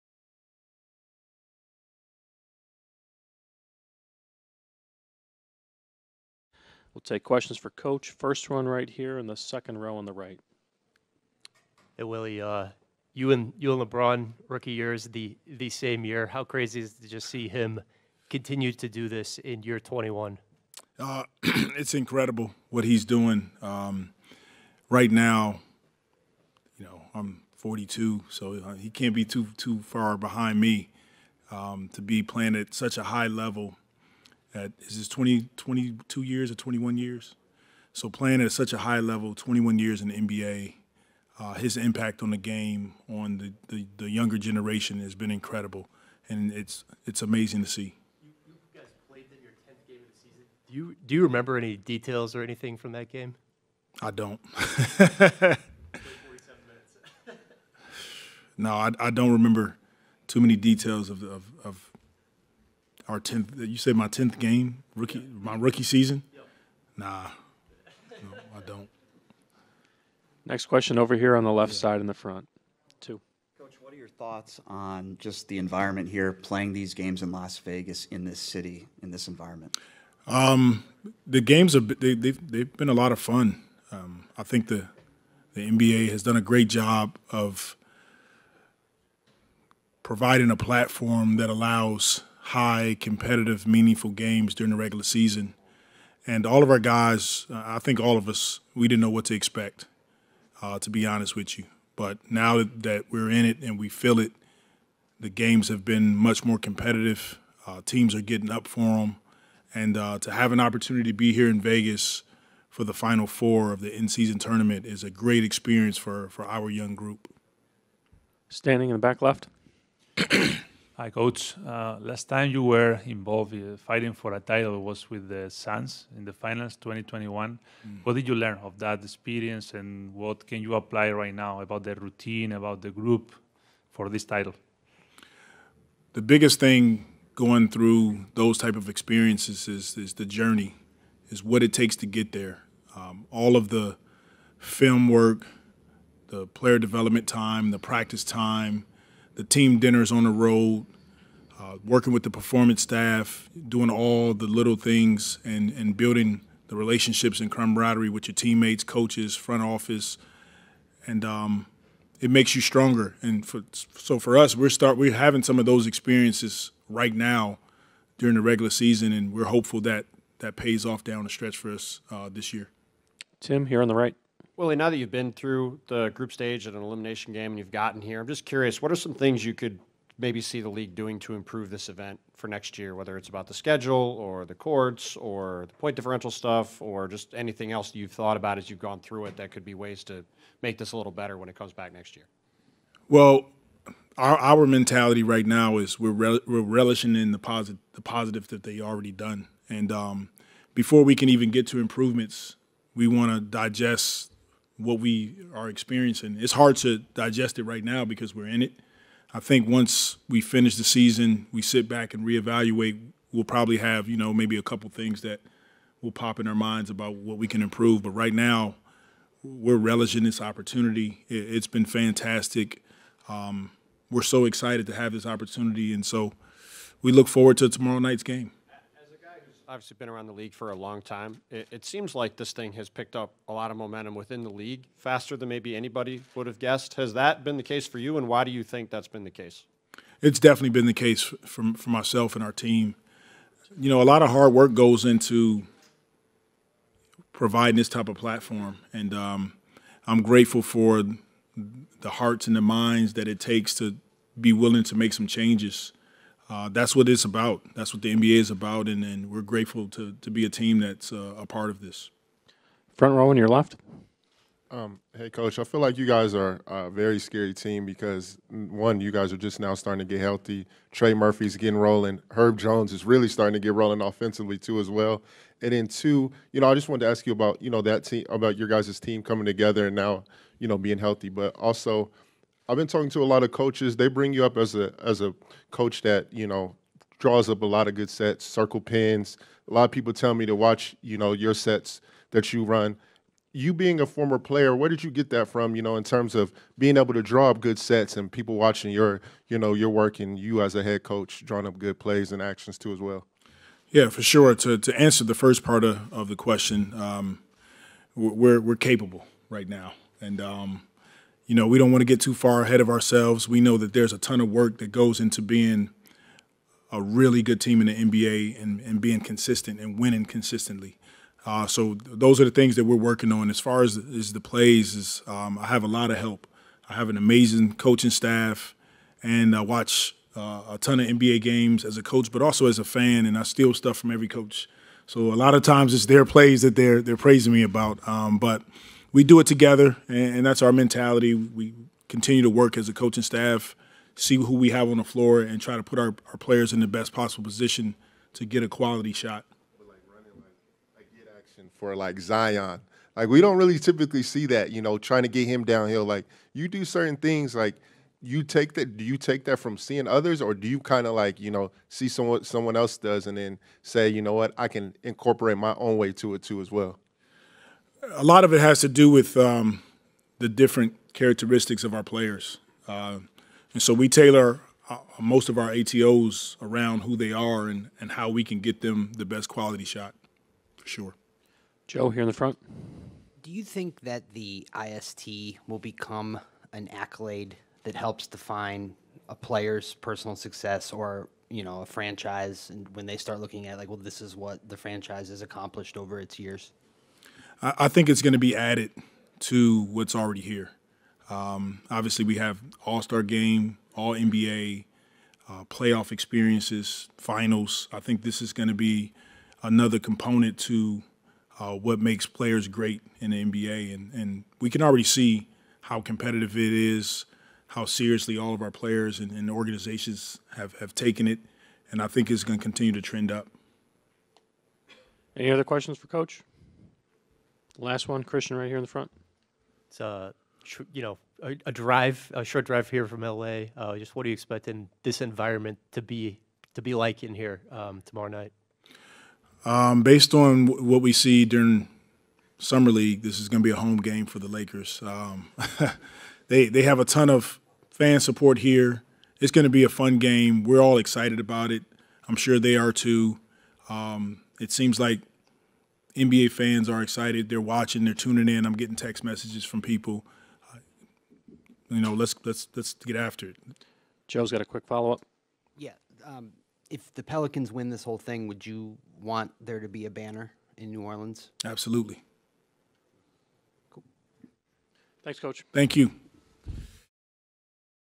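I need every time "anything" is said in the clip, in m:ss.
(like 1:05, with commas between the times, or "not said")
0:52, 3:07.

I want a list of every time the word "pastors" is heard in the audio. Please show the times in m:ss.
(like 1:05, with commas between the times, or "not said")
not said.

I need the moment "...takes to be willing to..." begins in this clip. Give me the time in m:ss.
4:13.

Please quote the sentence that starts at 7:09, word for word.
It's a uh, you know, a, a, drive, a short drive here from LA.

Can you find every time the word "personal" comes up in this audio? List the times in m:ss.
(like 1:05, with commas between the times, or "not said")
6:29.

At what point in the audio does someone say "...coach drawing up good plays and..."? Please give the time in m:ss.
5:01.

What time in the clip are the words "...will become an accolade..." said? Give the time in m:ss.
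6:25.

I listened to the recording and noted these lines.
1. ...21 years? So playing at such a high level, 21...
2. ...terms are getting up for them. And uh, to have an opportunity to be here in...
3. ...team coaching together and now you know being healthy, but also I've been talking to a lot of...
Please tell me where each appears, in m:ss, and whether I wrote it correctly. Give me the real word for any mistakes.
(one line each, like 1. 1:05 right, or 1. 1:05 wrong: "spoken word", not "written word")
1. 0:36 right
2. 1:47 wrong: "teams", not "terms"
3. 4:38 wrong: "coming", not "coaching".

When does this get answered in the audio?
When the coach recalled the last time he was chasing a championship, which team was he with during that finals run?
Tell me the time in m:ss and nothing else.
2:05.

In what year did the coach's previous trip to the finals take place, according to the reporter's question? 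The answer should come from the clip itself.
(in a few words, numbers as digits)
2021.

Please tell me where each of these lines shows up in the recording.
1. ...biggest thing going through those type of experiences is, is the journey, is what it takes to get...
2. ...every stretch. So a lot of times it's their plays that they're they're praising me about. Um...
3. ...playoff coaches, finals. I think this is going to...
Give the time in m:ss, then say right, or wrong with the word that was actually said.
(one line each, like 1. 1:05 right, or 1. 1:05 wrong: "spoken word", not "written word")
1. 2:16 right
2. 5:34 wrong: "coach", not "stretch"
3. 6:45 wrong: "experiences", not "coaches".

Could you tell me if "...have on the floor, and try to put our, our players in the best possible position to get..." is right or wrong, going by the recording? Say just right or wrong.
right.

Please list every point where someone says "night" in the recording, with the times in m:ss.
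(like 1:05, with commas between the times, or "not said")
3:47, 7:18.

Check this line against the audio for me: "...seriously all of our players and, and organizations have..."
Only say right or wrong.
right.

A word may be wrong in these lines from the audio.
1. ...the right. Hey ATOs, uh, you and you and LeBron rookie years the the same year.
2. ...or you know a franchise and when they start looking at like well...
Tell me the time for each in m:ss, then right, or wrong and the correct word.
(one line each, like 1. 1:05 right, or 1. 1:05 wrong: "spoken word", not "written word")
1. 0:10 wrong: "Willie", not "ATOs"
2. 6:30 right.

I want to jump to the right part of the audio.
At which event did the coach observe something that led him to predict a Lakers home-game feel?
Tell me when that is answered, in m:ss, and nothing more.
7:22.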